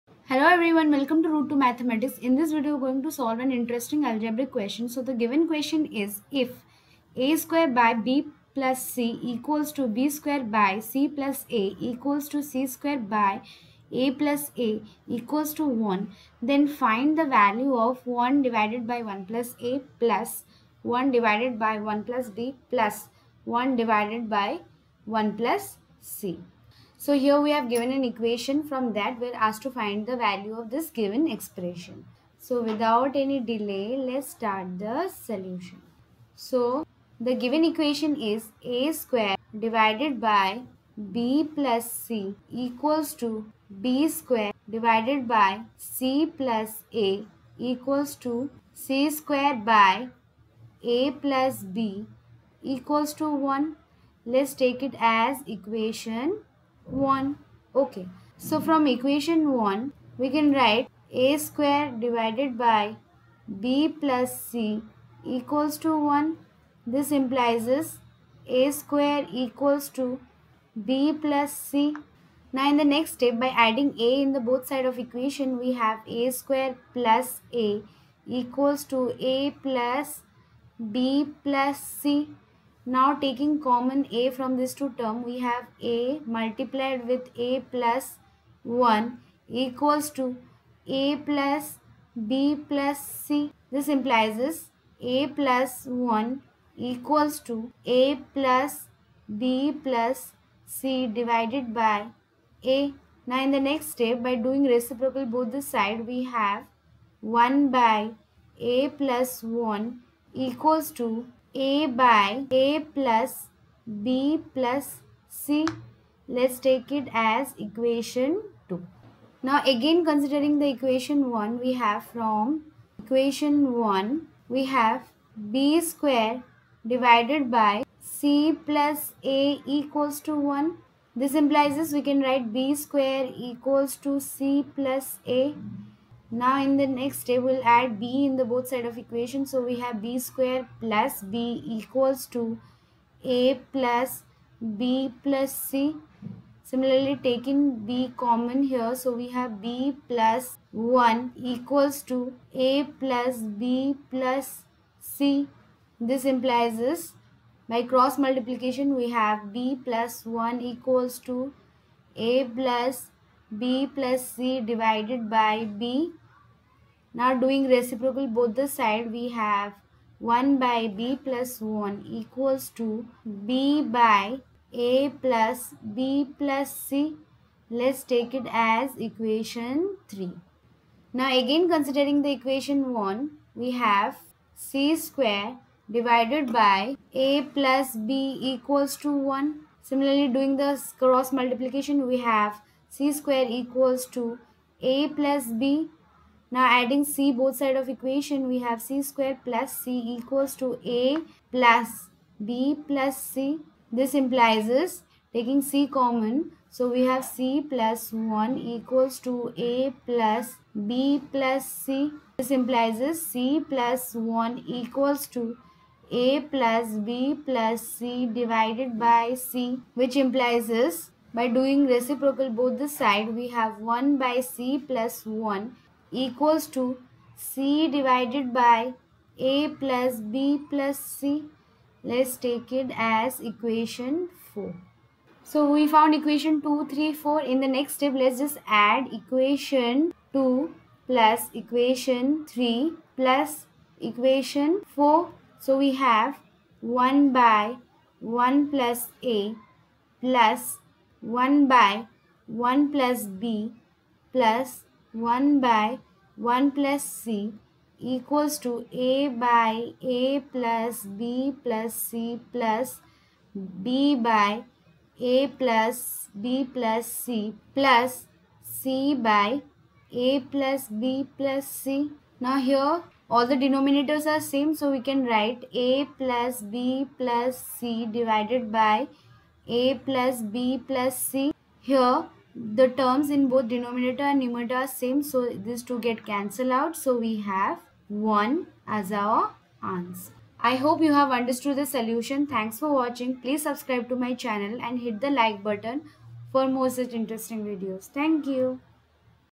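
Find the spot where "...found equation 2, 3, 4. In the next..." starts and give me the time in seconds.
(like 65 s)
235 s.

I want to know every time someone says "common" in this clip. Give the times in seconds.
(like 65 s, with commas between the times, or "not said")
83 s, 148 s, 205 s.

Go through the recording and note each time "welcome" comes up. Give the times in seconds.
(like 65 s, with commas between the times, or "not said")
0 s.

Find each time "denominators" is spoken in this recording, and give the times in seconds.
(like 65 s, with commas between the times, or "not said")
273 s, 283 s.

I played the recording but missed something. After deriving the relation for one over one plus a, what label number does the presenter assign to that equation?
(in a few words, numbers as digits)
2.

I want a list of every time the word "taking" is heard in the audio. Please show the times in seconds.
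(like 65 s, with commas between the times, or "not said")
83 s, 147 s, 205 s.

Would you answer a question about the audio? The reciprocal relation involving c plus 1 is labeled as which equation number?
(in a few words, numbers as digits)
4.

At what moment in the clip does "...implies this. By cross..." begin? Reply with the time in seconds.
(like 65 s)
156 s.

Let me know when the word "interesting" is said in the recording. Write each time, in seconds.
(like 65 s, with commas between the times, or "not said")
3 s, 297 s.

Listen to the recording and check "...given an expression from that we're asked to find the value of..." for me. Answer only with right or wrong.
wrong.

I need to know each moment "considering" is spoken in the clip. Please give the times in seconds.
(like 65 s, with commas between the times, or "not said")
120 s, 181 s.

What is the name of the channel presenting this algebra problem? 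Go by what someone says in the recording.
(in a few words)
Route to Mathematics.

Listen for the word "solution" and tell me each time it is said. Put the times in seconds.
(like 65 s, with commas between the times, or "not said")
35 s, 291 s.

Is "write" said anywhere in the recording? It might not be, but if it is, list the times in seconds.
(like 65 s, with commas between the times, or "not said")
60 s, 132 s, 275 s.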